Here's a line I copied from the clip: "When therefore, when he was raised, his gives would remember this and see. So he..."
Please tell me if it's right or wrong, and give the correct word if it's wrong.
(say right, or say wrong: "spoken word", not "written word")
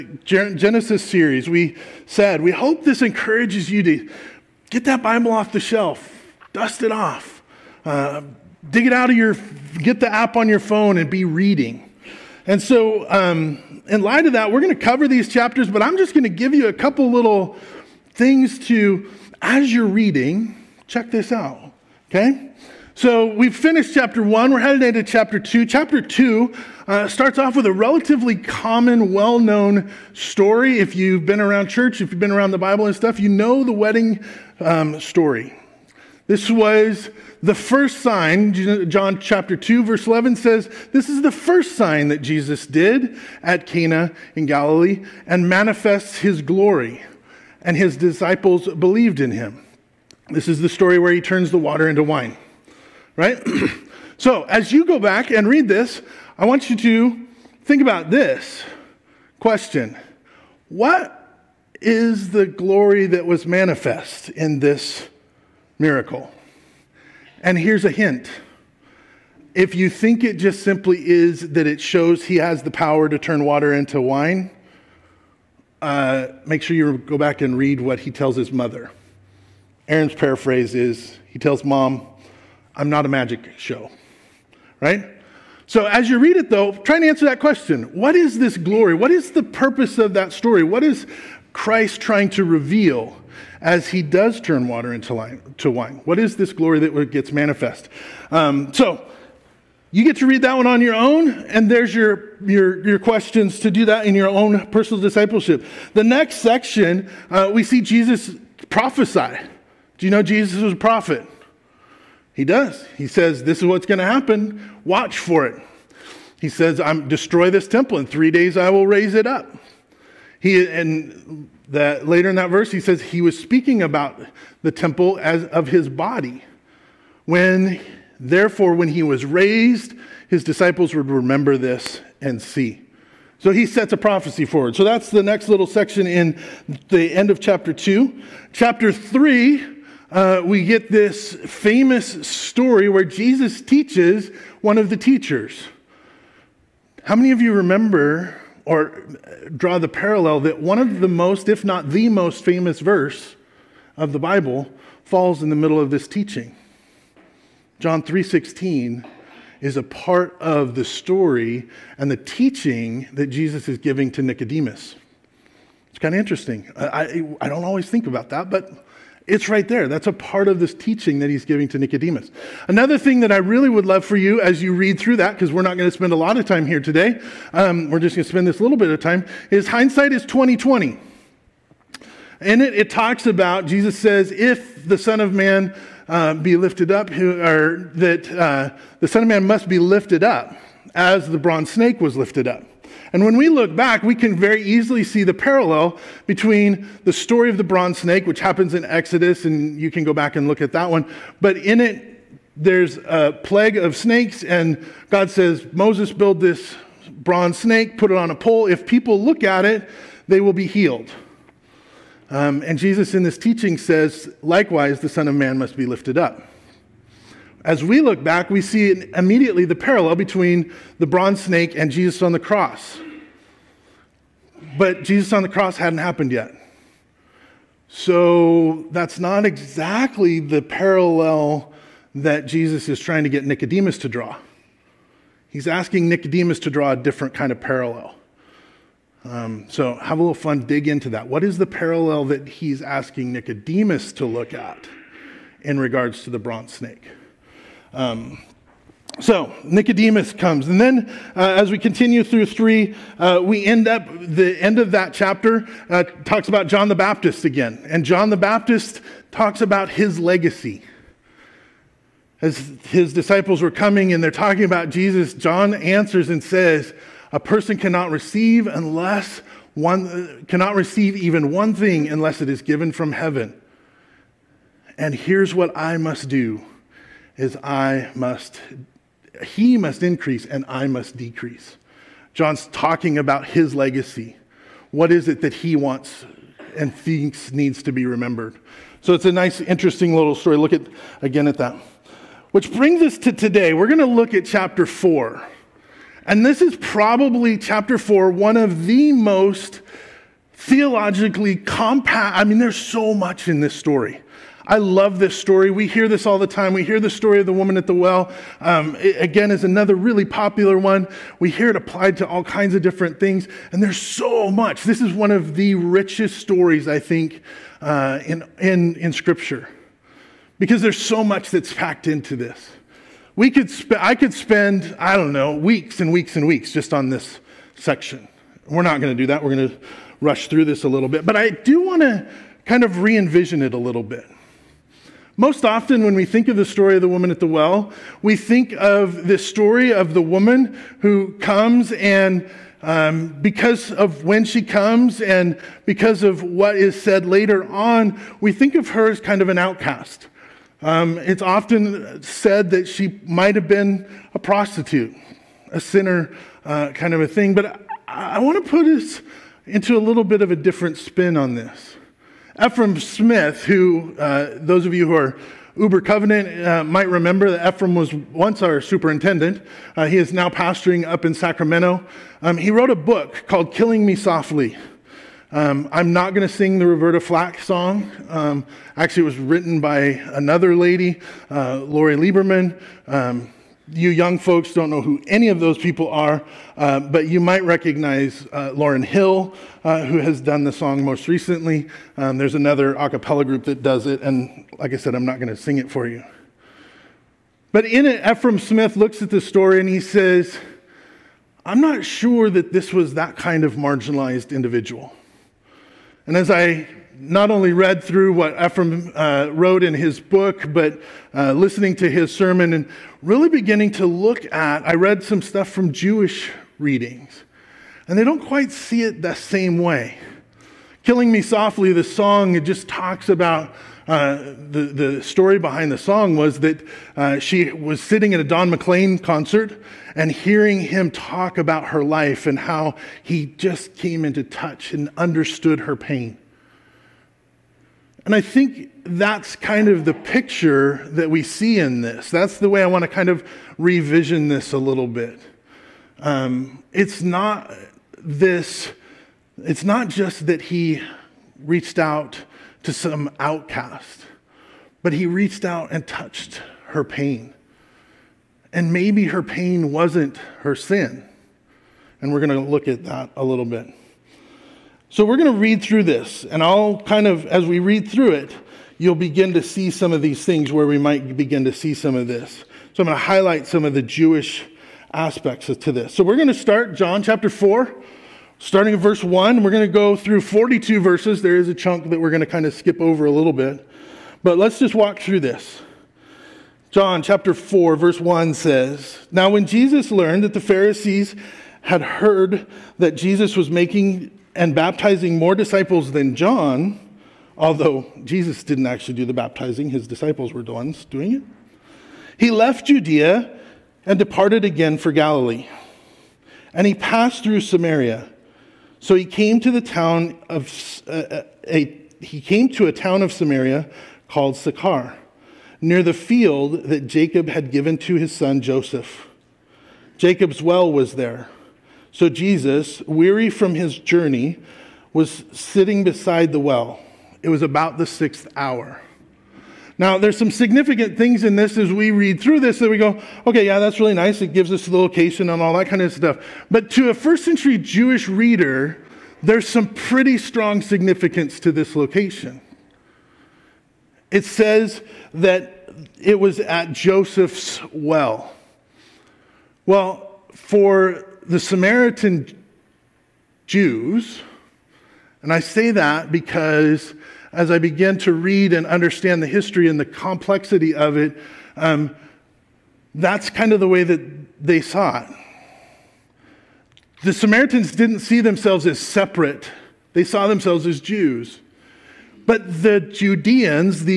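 wrong: "disciples", not "gives".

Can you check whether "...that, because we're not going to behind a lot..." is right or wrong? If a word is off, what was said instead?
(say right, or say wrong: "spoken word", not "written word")
wrong: "spend", not "behind".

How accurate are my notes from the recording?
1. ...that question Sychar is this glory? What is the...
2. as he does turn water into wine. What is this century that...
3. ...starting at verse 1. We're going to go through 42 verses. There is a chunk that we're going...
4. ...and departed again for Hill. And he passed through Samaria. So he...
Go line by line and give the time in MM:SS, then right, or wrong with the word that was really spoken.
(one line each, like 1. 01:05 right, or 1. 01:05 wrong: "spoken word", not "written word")
1. 01:27 wrong: "What", not "Sychar"
2. 01:33 wrong: "glory", not "century"
3. 07:58 right
4. 08:24 wrong: "Galilee", not "Hill".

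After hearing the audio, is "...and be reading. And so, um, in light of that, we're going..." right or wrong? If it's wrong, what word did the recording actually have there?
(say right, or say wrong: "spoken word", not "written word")
right.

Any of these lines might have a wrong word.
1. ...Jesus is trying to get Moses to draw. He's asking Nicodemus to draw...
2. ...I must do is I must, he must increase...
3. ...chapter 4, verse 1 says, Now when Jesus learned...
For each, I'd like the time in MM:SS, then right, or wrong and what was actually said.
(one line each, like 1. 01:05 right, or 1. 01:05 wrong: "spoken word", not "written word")
1. 03:52 wrong: "Nicodemus", not "Moses"
2. 04:35 right
3. 08:07 right.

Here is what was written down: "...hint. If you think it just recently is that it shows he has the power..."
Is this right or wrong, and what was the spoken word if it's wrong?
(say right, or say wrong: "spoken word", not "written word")
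wrong: "simply", not "recently".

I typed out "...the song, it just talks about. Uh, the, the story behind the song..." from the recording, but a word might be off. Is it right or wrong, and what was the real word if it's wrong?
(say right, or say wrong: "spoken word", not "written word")
right.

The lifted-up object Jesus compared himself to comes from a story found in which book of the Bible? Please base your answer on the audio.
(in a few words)
Exodus.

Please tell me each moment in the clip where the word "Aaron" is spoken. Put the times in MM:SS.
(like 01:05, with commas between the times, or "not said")
01:19.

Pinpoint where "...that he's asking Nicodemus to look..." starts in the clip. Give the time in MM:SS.
04:02.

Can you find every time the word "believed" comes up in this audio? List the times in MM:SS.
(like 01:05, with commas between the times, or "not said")
00:48.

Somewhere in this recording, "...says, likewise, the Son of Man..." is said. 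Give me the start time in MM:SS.
03:33.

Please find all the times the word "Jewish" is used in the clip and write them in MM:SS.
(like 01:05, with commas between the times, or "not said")
06:55, 07:54, 08:57.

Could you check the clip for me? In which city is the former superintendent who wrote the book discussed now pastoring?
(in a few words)
Sacramento.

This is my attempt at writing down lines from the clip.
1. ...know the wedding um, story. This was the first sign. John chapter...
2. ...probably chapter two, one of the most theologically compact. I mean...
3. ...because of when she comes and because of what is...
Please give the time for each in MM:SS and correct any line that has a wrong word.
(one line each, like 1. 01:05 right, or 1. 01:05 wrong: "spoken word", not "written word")
1. 00:33 right
2. 04:56 wrong: "four", not "two"
3. 05:43 right.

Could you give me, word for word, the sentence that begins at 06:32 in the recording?
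Um, there's another a cappella group that does it, and like I said, I'm not going to sing it for you.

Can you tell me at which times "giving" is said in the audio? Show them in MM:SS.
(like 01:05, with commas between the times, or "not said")
02:43, 02:51.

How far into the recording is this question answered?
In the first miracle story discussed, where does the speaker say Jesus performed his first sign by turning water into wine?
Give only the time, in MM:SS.
00:43.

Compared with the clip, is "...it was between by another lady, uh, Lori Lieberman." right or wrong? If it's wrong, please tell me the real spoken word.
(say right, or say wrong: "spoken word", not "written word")
wrong: "written", not "between".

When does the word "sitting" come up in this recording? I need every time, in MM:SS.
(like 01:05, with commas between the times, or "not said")
07:07, 08:45.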